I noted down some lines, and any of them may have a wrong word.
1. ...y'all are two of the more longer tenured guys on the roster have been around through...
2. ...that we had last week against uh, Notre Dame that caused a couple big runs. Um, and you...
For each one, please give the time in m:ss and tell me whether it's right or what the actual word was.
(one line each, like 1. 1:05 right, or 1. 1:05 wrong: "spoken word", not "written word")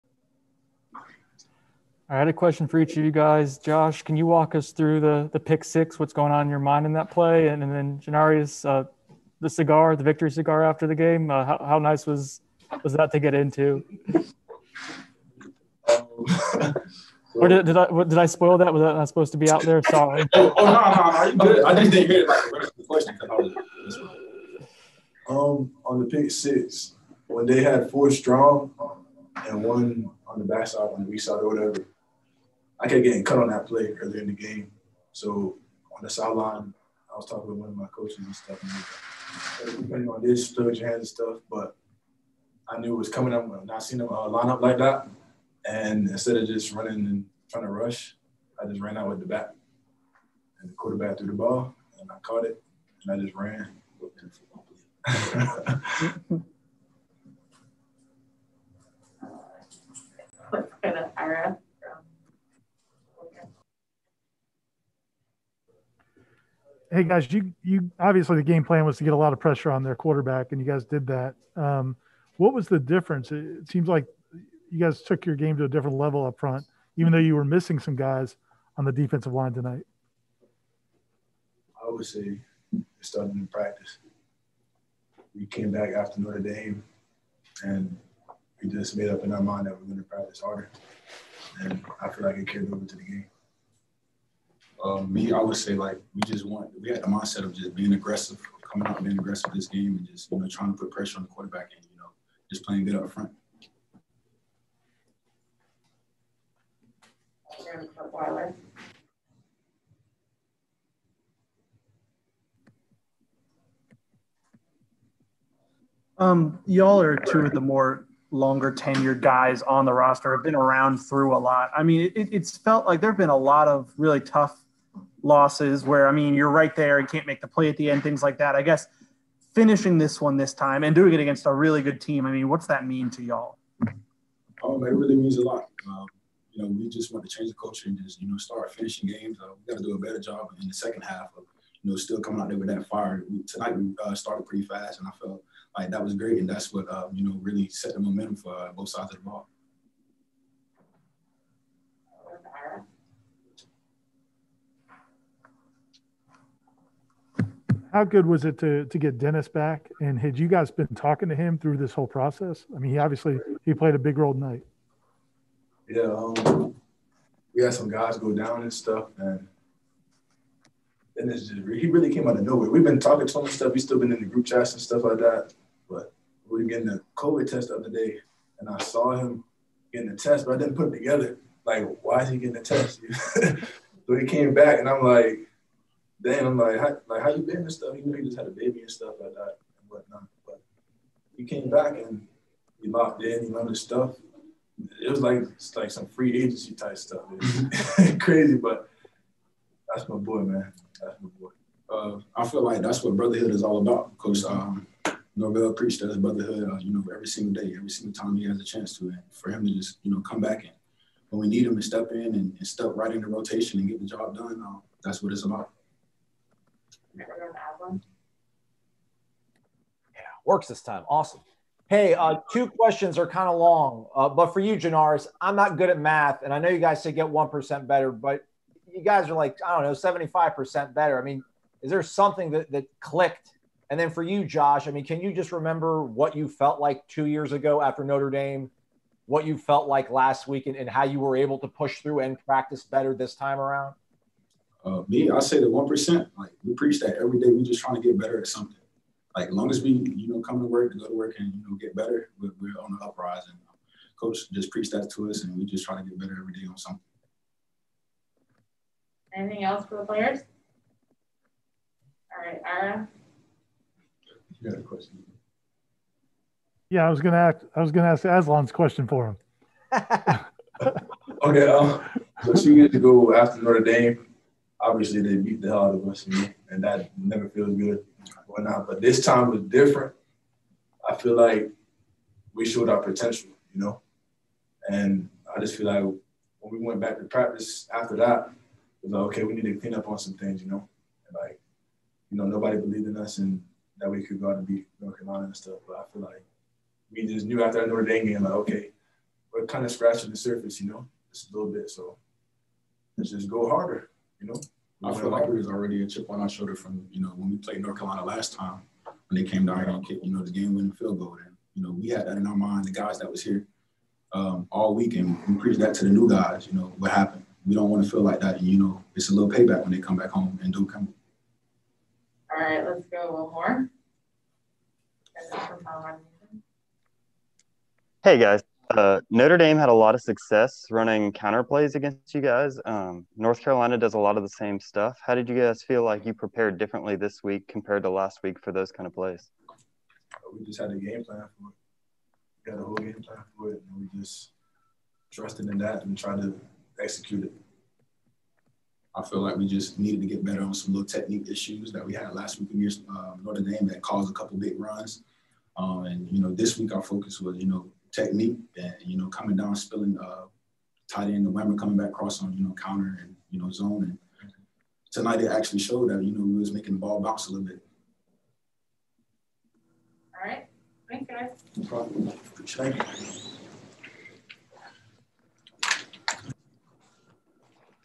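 1. 1:56 right
2. 5:51 right.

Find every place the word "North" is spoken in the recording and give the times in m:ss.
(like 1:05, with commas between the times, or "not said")
4:54, 5:07, 5:33.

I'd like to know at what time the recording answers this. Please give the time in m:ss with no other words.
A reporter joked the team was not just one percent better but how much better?
3:49.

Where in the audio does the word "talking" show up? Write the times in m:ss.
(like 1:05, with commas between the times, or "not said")
0:37, 2:40, 2:52.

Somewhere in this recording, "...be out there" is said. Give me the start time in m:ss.
0:19.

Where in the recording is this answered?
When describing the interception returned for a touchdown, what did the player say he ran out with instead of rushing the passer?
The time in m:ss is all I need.
0:49.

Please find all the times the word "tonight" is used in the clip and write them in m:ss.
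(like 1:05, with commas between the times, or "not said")
1:19, 2:23, 2:44, 6:05.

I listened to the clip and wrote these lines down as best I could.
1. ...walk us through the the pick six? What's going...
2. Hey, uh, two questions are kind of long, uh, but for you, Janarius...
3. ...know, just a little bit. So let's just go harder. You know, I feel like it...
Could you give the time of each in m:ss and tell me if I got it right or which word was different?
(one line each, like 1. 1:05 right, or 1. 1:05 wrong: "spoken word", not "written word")
1. 0:04 right
2. 3:41 right
3. 5:00 right.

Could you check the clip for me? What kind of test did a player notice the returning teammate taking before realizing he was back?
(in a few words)
COVID test.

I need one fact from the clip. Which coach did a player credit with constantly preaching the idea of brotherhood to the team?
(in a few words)
Norvell.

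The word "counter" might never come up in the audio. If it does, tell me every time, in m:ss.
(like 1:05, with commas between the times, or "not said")
5:31, 6:02.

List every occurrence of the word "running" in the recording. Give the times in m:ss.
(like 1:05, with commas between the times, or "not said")
0:46, 5:30.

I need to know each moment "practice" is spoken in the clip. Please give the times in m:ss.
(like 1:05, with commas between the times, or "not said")
1:23, 1:30, 4:02, 4:47.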